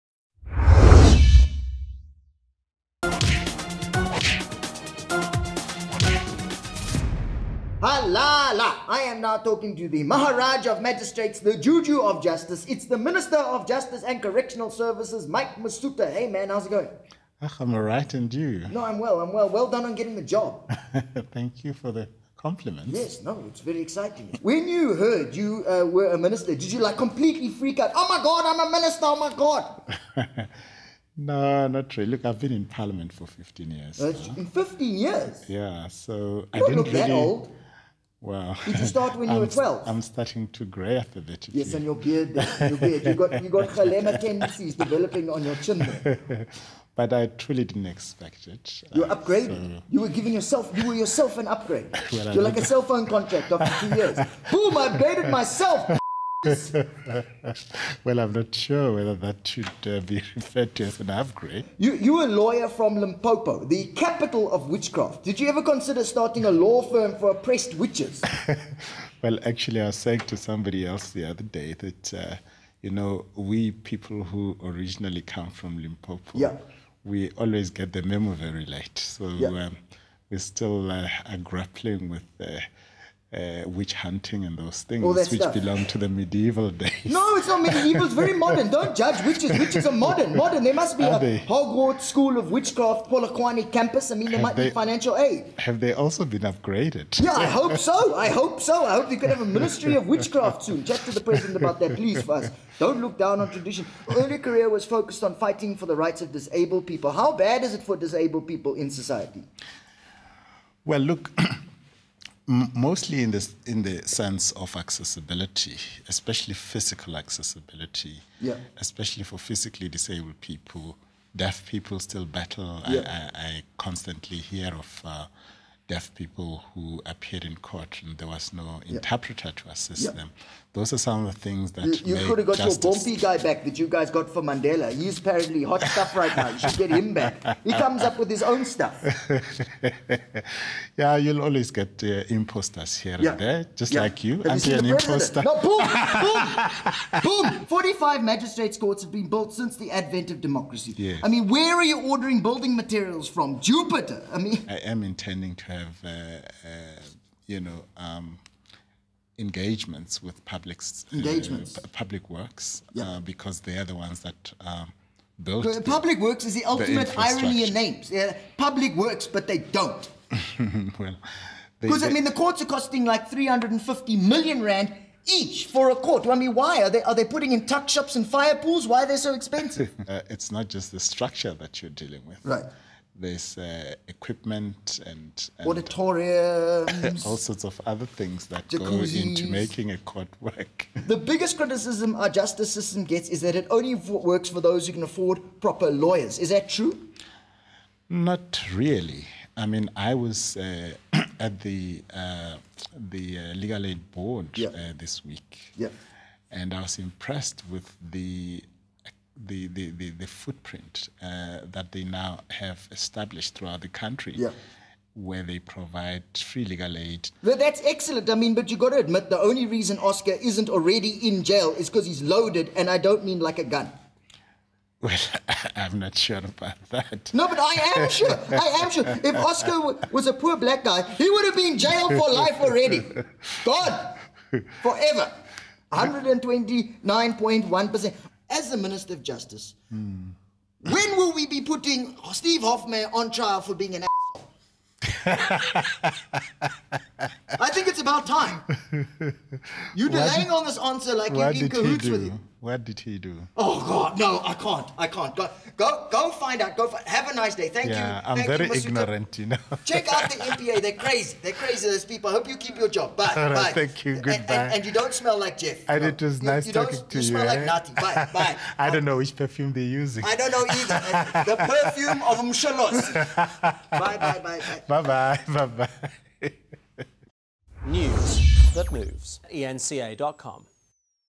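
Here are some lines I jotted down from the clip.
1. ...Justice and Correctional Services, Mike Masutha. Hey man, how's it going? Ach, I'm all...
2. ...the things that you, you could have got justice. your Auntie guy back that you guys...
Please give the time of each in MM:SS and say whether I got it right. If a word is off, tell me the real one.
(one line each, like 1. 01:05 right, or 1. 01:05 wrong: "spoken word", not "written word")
1. 00:13 right
2. 02:11 wrong: "Bumpy", not "Auntie".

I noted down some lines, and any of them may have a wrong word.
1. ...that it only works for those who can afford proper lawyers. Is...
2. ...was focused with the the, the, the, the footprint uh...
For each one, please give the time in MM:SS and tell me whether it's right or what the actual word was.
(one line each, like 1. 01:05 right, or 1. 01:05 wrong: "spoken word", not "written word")
1. 03:13 right
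2. 03:26 wrong: "impressed", not "focused".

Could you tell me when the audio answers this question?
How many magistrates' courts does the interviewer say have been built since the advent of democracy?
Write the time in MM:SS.
02:27.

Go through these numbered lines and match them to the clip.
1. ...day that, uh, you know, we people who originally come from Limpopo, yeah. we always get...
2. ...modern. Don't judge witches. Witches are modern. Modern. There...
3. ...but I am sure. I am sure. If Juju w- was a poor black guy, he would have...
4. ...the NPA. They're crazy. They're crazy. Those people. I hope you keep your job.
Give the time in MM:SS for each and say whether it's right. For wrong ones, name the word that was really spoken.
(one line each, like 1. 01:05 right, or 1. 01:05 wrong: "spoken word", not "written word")
1. 01:11 right
2. 01:28 right
3. 03:47 wrong: "Oscar", not "Juju"
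4. 04:20 right.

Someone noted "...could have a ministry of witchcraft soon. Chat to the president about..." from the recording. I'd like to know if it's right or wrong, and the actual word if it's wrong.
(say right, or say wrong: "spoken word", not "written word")
right.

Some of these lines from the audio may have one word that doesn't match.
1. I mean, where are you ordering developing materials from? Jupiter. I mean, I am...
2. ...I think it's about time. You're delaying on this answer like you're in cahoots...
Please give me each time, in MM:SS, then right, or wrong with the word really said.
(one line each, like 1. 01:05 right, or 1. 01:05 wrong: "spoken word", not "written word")
1. 02:31 wrong: "building", not "developing"
2. 04:07 right.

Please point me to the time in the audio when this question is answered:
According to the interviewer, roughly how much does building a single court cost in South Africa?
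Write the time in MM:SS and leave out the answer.
02:53.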